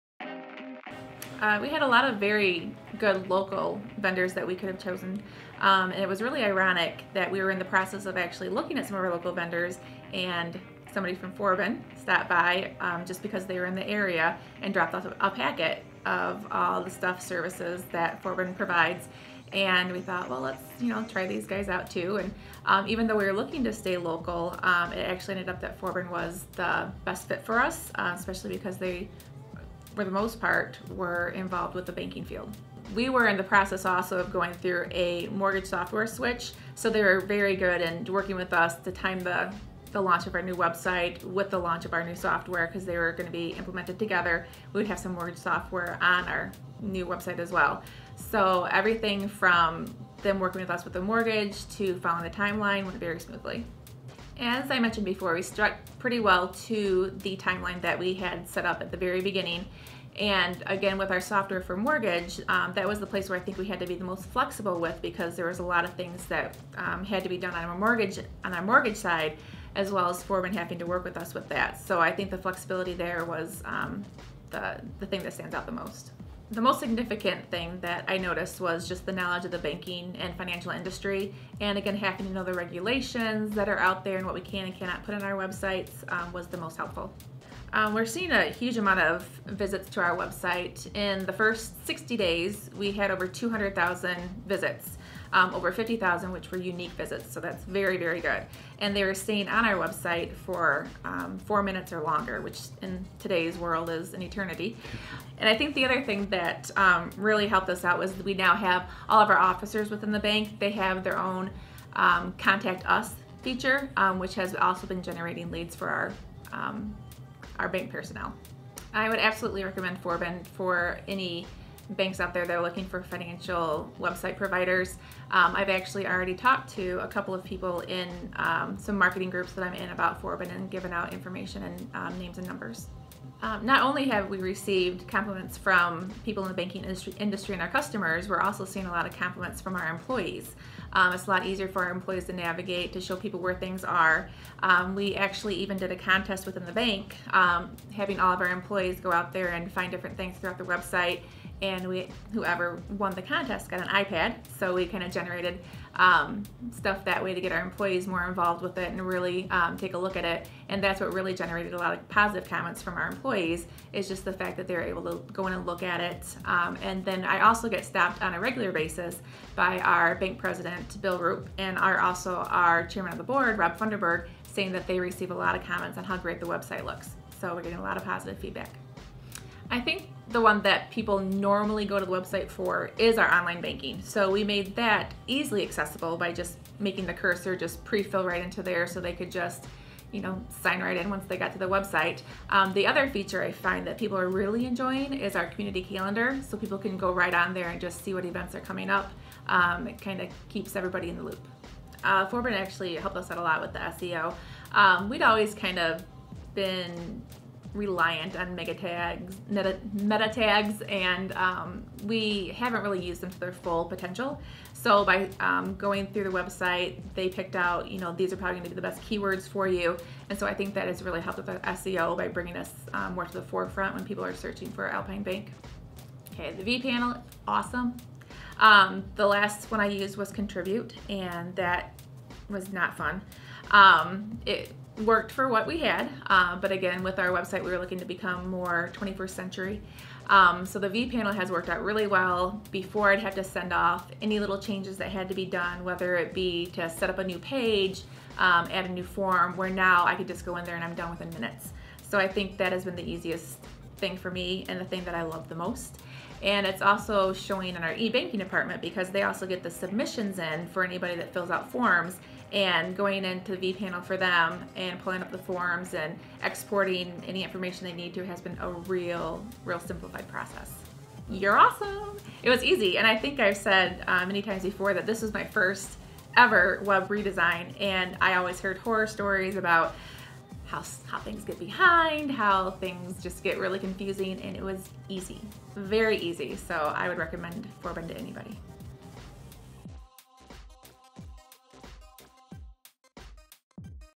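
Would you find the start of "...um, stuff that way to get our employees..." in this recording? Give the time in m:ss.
2:35.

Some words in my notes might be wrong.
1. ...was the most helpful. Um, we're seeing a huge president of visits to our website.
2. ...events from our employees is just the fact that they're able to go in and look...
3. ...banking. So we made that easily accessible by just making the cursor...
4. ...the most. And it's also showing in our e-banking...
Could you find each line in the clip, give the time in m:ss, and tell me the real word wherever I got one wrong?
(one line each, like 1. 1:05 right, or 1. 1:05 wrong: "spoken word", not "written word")
1. 1:26 wrong: "amount", not "president"
2. 2:42 wrong: "comments", not "events"
3. 3:03 right
4. 4:15 right.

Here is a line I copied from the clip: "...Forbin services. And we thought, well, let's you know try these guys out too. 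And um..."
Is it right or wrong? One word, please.
wrong.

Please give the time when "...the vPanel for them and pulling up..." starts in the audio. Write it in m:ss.
4:23.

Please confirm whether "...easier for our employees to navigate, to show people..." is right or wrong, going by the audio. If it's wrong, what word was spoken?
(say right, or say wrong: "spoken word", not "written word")
right.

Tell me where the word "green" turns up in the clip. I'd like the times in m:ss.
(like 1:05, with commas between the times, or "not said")
not said.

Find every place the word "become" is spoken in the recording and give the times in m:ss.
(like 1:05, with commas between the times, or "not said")
3:58.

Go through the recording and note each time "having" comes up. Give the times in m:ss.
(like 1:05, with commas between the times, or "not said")
1:10, 1:21, 2:27.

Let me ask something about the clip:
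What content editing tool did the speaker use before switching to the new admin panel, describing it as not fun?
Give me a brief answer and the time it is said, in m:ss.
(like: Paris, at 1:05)
Contribute, at 3:50.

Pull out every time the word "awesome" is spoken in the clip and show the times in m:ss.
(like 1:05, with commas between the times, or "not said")
3:47, 4:31.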